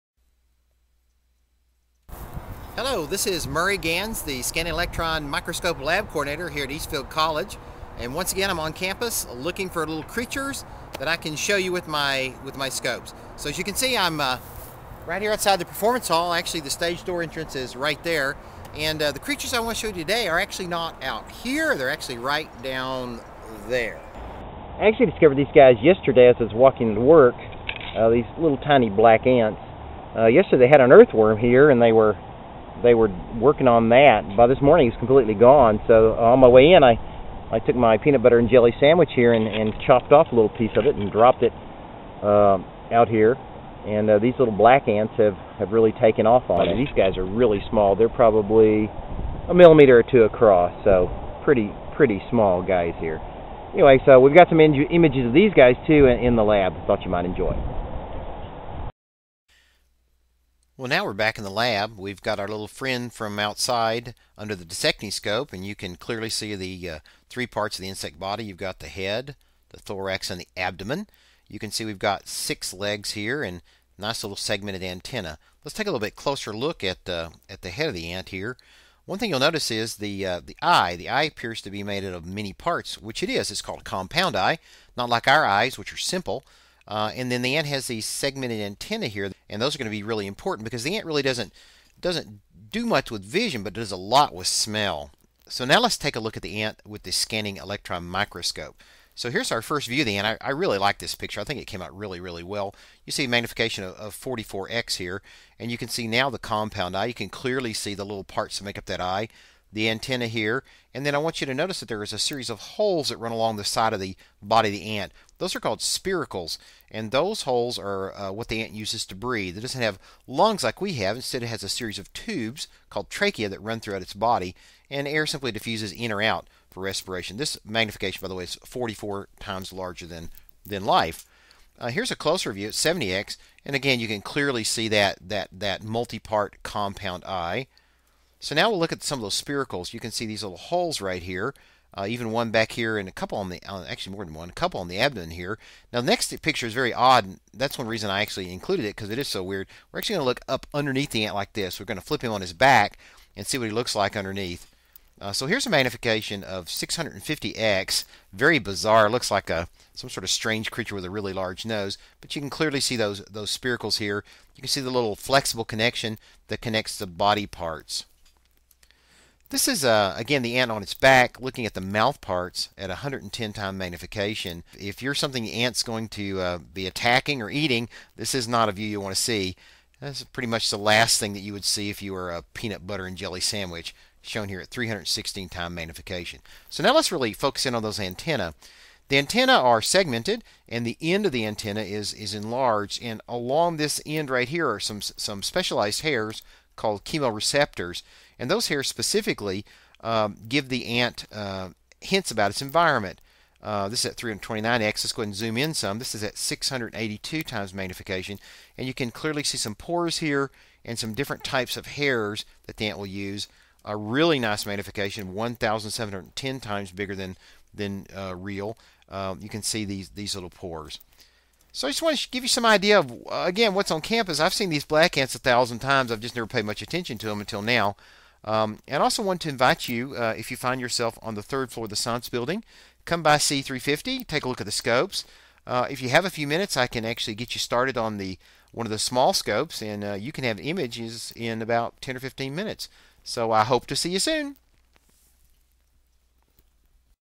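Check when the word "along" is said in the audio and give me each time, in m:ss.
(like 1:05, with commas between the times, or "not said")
1:53, 3:13.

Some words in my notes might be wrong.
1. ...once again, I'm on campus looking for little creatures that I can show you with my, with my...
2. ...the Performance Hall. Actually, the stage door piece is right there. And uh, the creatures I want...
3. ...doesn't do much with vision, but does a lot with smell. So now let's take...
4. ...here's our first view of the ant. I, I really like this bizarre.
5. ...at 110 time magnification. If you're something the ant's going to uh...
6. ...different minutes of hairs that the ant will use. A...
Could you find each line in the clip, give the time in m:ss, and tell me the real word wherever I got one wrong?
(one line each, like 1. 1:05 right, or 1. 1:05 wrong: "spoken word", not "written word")
1. 0:08 right
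2. 0:15 wrong: "entrance", not "piece"
3. 1:31 right
4. 1:39 wrong: "picture", not "bizarre"
5. 2:52 right
6. 3:31 wrong: "types", not "minutes".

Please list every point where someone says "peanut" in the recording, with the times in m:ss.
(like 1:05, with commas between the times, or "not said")
0:37, 3:02.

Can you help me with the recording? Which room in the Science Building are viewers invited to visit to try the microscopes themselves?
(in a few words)
C350.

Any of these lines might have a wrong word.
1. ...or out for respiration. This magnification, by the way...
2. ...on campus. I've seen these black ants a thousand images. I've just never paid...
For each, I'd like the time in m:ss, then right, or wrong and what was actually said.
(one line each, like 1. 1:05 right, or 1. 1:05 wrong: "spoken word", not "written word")
1. 2:06 right
2. 3:43 wrong: "times", not "images".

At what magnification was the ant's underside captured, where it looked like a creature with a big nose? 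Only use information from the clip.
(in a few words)
650x.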